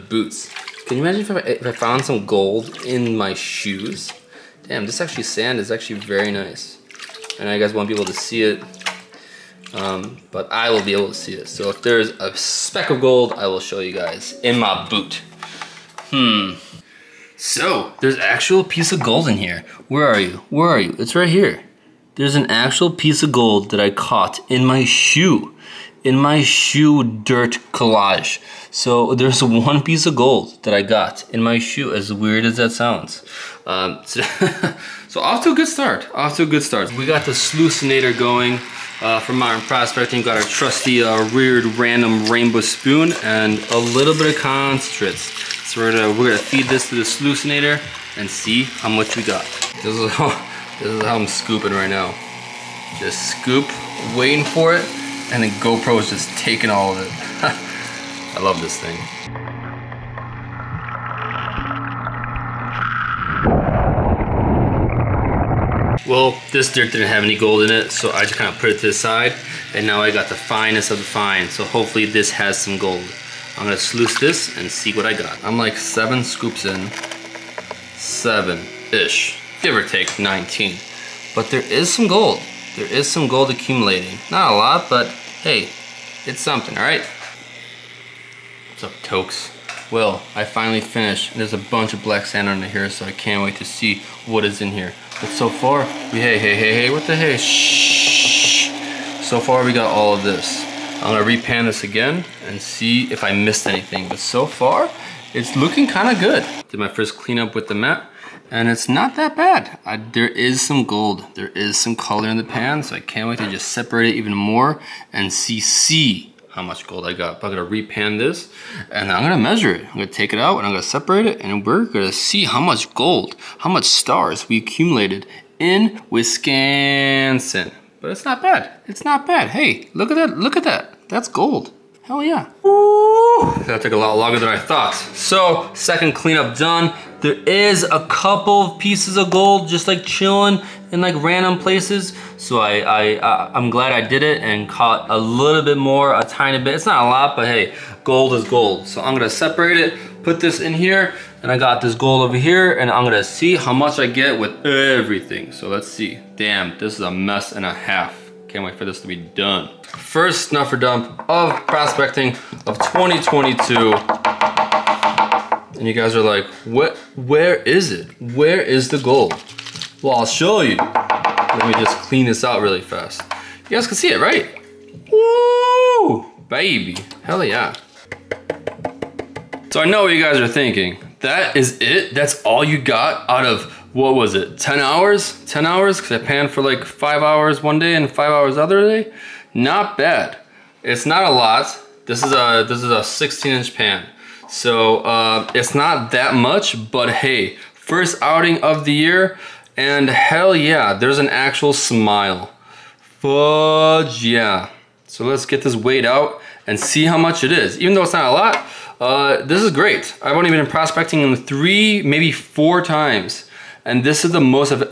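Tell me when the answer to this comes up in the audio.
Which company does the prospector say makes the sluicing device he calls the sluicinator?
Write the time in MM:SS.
00:39.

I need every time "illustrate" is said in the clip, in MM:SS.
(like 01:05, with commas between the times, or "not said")
not said.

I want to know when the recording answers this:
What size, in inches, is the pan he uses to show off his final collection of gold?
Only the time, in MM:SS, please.
03:13.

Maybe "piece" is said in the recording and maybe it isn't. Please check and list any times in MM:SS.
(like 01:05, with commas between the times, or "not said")
00:18, 00:22, 00:29, 02:18.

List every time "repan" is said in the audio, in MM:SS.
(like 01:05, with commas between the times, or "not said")
01:41, 01:57.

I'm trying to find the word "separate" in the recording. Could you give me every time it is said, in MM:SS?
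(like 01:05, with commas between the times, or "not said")
01:53, 02:00, 02:29.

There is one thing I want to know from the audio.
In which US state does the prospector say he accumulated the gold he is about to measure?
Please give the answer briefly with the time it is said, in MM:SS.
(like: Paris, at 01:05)
Wisconsin, at 02:06.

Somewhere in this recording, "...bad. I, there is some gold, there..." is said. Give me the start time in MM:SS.
01:49.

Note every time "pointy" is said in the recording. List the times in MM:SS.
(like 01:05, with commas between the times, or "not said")
not said.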